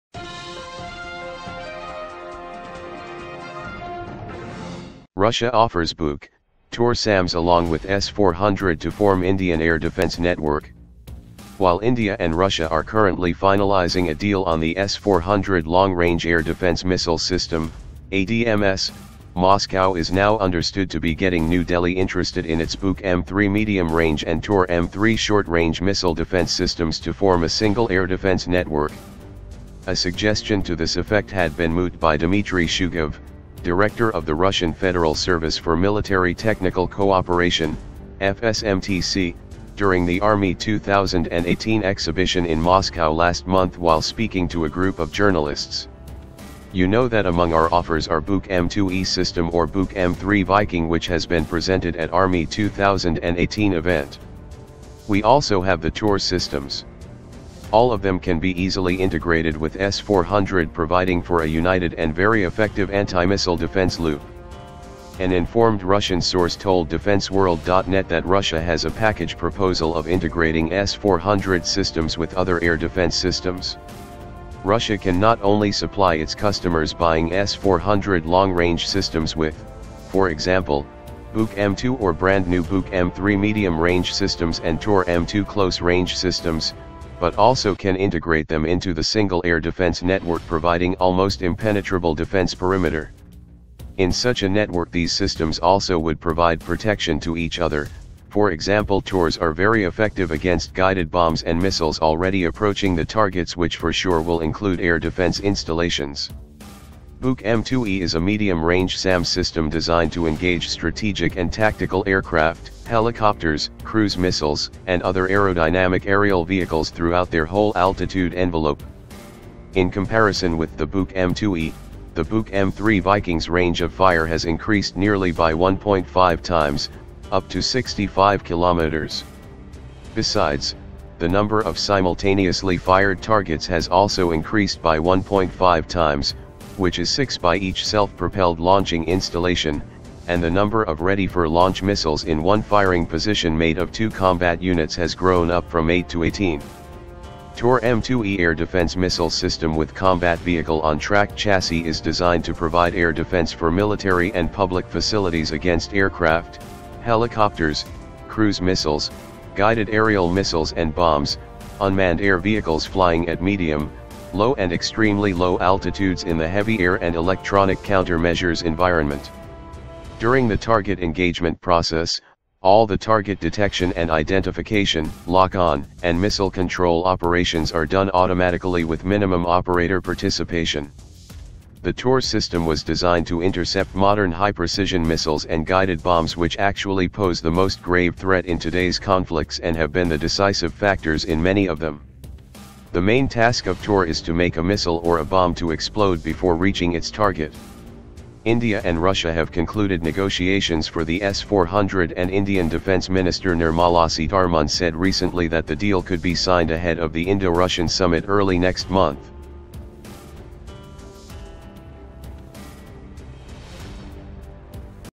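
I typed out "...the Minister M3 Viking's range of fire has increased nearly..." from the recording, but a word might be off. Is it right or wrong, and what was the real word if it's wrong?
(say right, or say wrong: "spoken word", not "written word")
wrong: "Buk", not "Minister".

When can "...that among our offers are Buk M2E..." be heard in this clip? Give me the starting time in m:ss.
0:47.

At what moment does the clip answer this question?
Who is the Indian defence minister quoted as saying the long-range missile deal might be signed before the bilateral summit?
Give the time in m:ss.
3:23.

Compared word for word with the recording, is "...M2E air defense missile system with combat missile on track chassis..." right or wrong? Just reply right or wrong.
wrong.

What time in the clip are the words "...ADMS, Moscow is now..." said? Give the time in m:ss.
0:18.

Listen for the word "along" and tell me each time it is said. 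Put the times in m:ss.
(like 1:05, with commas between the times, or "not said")
0:07.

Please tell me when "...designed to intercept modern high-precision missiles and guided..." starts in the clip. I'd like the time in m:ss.
3:02.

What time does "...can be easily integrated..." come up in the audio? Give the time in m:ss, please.
0:58.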